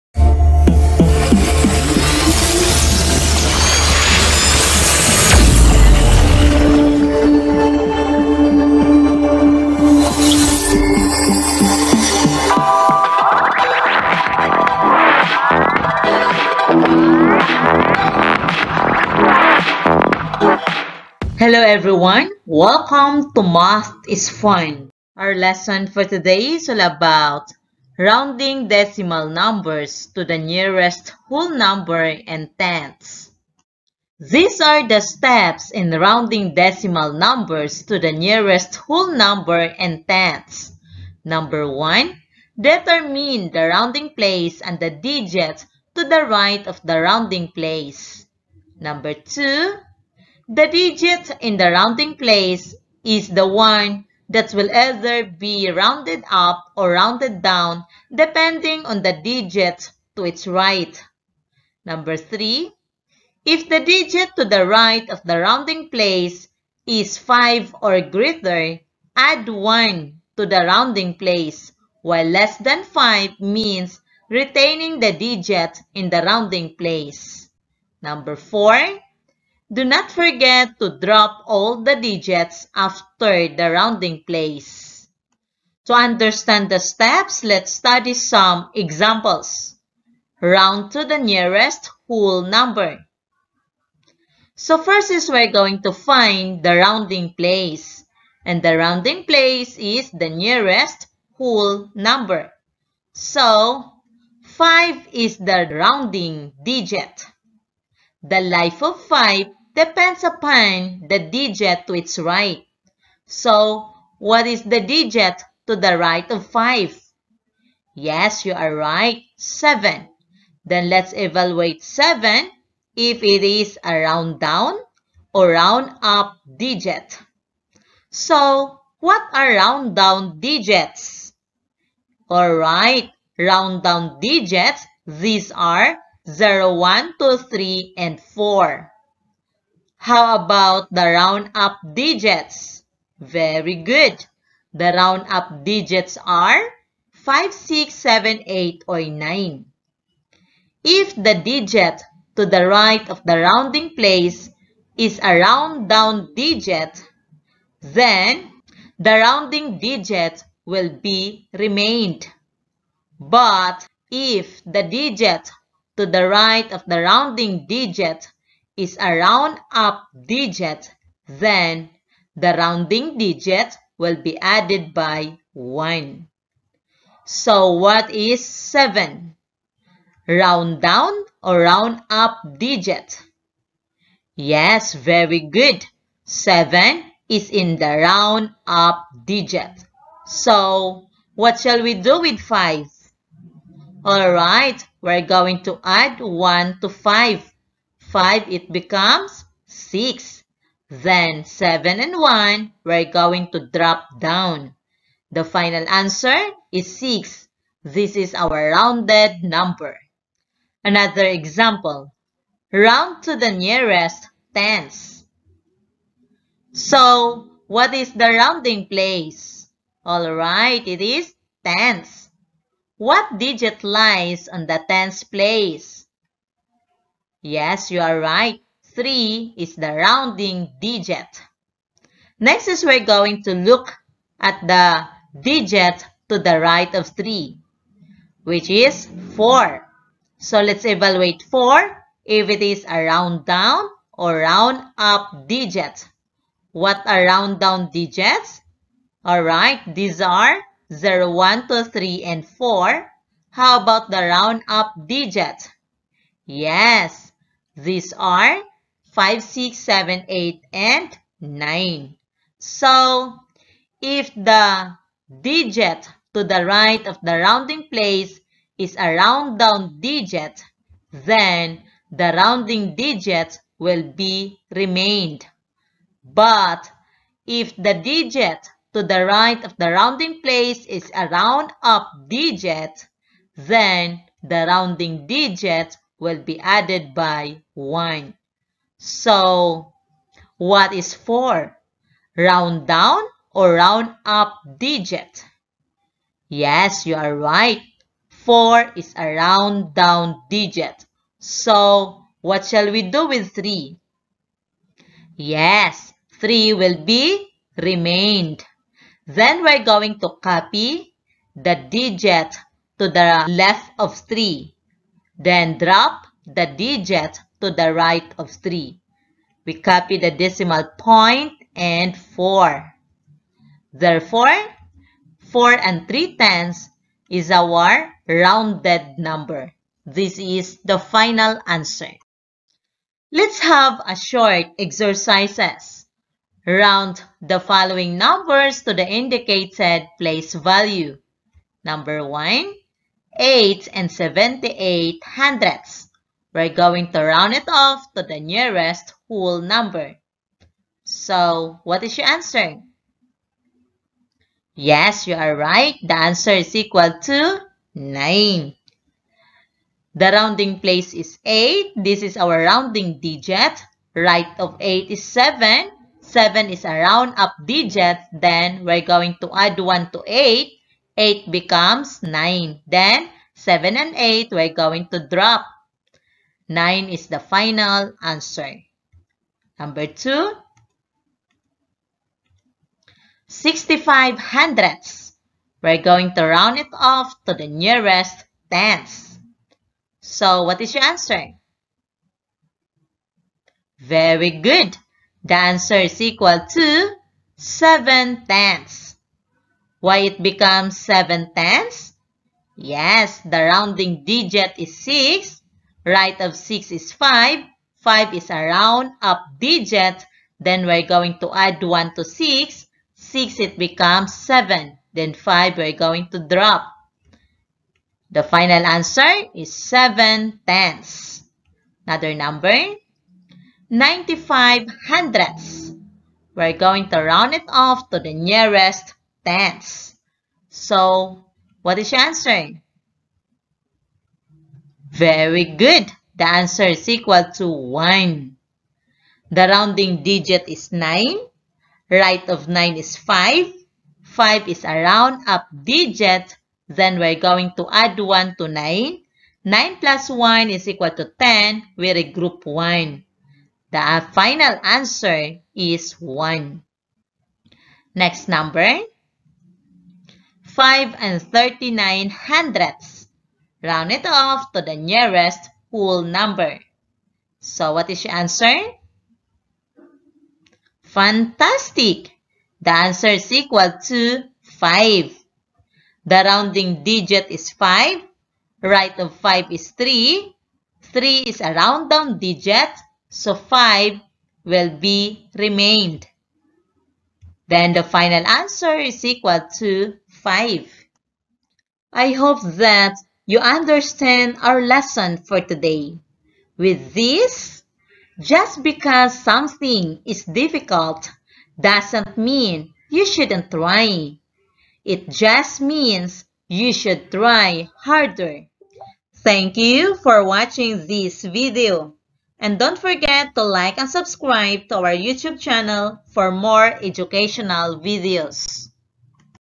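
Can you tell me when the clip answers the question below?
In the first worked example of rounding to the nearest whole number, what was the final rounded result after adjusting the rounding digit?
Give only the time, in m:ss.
3:25.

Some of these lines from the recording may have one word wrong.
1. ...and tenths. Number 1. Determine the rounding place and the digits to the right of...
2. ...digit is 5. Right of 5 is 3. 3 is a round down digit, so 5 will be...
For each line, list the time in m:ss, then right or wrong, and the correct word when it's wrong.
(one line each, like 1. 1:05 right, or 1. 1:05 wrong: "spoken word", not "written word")
1. 0:39 right
2. 7:57 right.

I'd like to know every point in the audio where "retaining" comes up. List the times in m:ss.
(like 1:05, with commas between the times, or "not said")
1:14.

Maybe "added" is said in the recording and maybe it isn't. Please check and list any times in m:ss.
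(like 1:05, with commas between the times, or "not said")
2:54, 4:46.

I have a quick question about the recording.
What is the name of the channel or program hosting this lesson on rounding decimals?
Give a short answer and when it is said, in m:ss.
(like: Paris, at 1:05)
Math is Fun, at 0:23.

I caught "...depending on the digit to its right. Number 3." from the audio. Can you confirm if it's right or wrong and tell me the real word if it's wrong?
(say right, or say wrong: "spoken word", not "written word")
right.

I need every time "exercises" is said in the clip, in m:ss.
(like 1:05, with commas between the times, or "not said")
5:34.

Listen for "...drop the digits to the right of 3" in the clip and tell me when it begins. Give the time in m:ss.
5:15.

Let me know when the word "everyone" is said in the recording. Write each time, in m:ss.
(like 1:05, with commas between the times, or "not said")
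0:21.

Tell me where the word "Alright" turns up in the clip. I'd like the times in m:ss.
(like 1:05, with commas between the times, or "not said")
2:12, 3:14, 3:40, 4:09.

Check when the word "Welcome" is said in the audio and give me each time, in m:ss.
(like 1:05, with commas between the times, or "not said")
0:22.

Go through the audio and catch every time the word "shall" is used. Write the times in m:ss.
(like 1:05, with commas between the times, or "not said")
3:11, 5:02.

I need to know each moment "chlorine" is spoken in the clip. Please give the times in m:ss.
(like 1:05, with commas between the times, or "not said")
not said.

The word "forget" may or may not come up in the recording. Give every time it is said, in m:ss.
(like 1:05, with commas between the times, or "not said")
1:20, 8:32.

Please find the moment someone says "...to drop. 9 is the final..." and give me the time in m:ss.
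6:15.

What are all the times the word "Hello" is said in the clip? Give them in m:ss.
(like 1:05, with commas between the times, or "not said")
0:21.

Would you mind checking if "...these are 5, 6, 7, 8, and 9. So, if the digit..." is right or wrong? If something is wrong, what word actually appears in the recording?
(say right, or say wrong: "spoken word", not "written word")
right.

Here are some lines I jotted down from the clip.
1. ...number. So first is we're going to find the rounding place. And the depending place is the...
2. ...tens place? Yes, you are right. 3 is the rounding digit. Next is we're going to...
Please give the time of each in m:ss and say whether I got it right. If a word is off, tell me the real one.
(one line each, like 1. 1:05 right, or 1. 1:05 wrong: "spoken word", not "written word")
1. 1:32 wrong: "rounding", not "depending"
2. 3:44 right.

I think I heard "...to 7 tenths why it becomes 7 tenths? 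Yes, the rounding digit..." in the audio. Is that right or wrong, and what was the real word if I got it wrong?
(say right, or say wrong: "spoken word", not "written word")
right.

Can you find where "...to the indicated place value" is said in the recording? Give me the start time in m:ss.
5:38.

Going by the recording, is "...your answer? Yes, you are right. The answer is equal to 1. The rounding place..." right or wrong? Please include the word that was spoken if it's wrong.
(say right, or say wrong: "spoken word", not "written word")
wrong: "9", not "1".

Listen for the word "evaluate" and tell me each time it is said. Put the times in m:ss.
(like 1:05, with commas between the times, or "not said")
2:01, 4:00.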